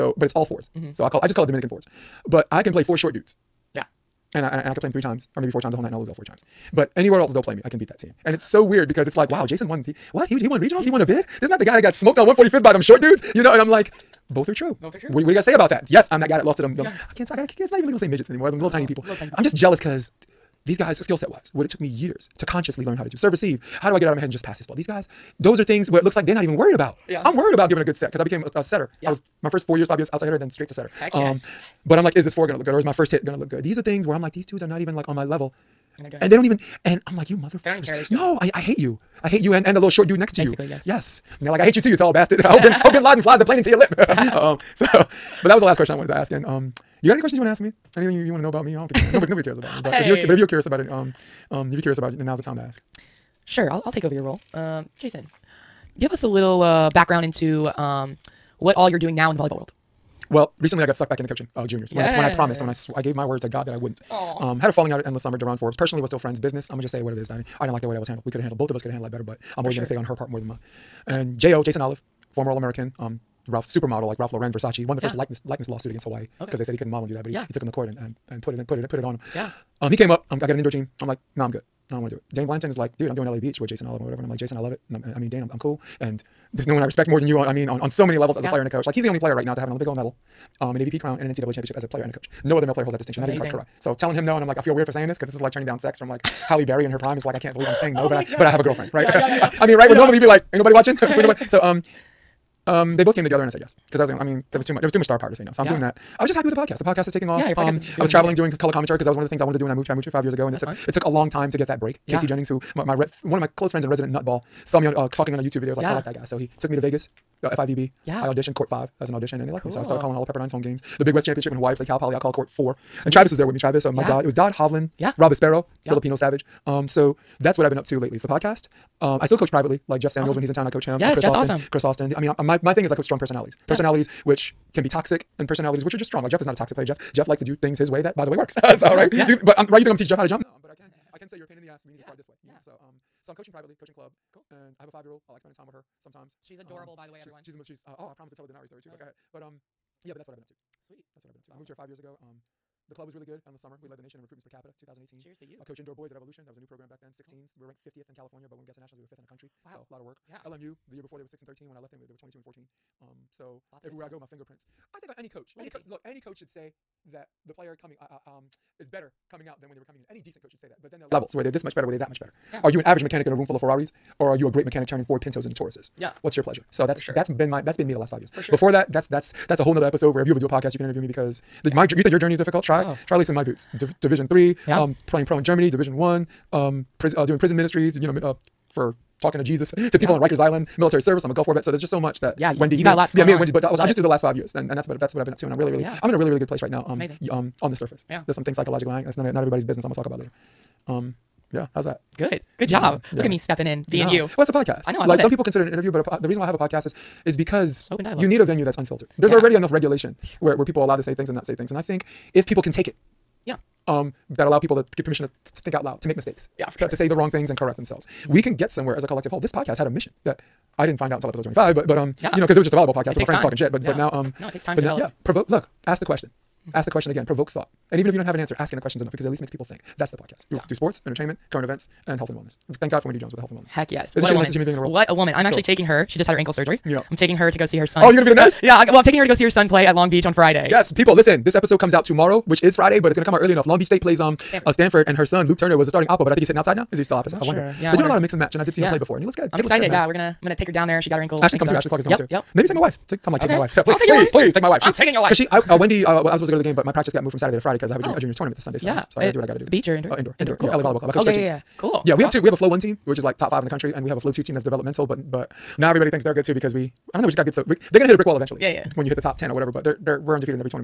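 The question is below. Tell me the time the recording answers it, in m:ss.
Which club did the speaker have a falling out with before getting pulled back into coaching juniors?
1:05.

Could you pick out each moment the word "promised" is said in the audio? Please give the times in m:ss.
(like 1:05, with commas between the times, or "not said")
1:02, 2:28.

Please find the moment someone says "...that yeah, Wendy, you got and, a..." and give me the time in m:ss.
3:12.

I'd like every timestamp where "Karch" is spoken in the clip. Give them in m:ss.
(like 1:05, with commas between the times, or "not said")
1:33.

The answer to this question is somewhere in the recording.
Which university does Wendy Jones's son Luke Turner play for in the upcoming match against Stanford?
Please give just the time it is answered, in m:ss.
4:03.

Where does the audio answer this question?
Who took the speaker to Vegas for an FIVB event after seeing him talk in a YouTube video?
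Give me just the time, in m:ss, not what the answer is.
1:52.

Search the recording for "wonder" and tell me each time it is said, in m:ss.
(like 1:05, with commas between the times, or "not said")
4:07.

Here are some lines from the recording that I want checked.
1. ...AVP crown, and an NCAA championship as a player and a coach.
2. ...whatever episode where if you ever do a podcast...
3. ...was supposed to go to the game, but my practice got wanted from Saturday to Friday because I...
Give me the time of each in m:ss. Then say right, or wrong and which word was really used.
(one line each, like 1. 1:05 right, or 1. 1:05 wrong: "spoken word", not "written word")
1. 1:30 right
2. 2:59 wrong: "nother", not "whatever"
3. 4:16 wrong: "moved", not "wanted".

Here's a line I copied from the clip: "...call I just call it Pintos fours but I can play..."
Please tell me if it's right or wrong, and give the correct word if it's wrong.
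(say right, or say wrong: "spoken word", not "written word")
wrong: "Dominican", not "Pintos".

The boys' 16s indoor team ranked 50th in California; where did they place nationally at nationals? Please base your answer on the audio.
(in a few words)
5th.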